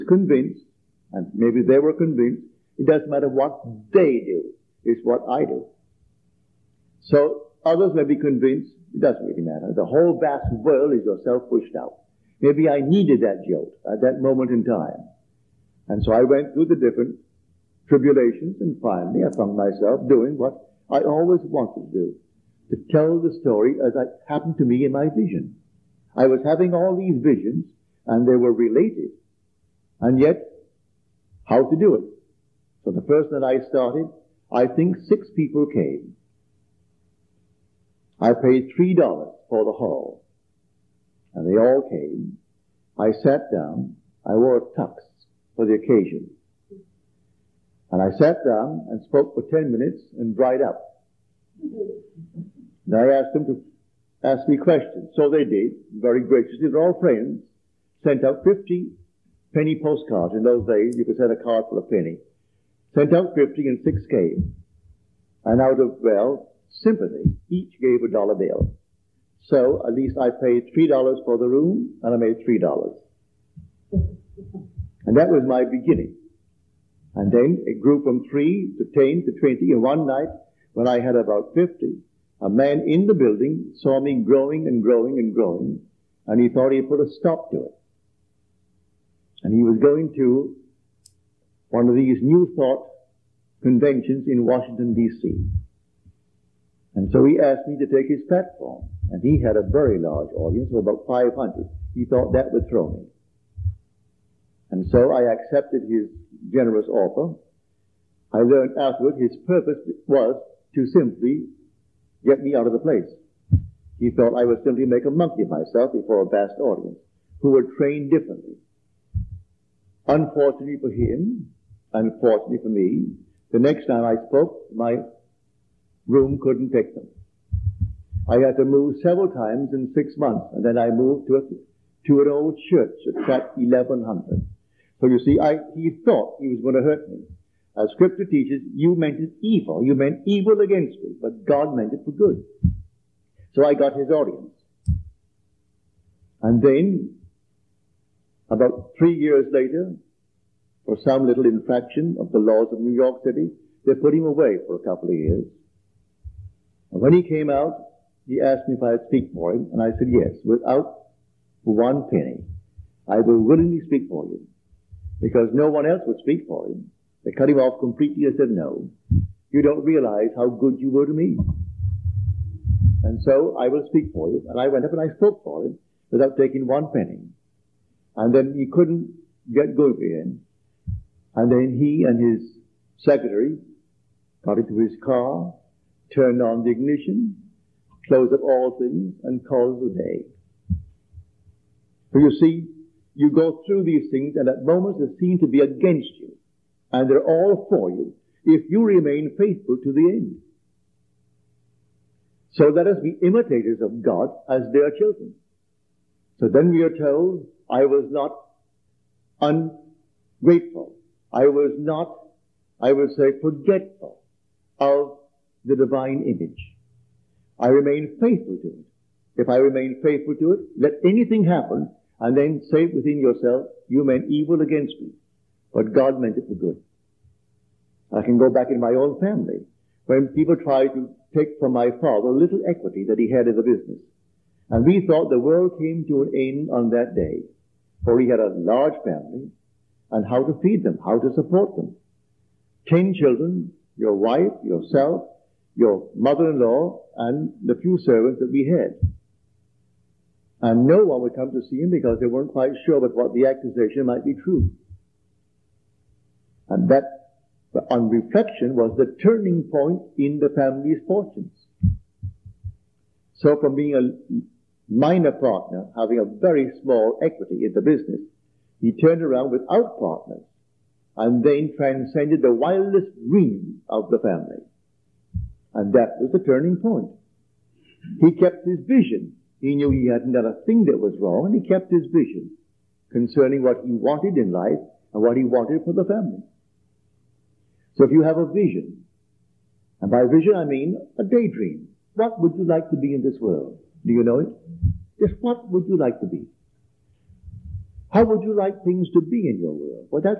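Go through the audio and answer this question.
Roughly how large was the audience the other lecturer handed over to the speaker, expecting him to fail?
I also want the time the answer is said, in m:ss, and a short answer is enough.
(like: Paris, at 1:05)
500, at 1:40.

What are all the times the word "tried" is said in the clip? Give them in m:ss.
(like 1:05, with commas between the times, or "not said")
3:50.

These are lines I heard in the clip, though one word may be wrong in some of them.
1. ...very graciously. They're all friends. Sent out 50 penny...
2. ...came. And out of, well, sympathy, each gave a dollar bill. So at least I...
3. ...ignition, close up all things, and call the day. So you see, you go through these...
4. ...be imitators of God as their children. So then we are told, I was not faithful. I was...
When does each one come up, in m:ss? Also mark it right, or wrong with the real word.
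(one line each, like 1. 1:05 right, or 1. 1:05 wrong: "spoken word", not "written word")
1. 0:55 right
2. 1:04 right
3. 3:06 right
4. 3:23 wrong: "ungrateful", not "faithful".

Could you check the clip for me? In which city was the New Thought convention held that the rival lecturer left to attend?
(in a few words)
Washington, D.C.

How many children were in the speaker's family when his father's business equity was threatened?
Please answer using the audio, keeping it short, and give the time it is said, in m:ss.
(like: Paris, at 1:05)
10, at 4:02.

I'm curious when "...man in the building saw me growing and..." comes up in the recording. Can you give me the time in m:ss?
1:22.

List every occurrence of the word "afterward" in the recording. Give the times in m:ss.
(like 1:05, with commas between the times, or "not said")
1:48.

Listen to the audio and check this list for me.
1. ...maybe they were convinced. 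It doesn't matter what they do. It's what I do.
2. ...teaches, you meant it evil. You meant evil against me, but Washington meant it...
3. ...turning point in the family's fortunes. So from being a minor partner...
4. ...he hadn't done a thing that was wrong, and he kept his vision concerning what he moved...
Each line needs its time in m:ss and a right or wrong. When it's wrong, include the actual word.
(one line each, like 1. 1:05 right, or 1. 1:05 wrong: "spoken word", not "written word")
1. 0:01 right
2. 2:18 wrong: "God", not "Washington"
3. 4:19 right
4. 4:39 wrong: "wanted", not "moved".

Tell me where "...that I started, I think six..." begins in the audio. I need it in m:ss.
0:33.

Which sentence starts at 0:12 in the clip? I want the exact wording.
Maybe I needed that jolt at that moment in time.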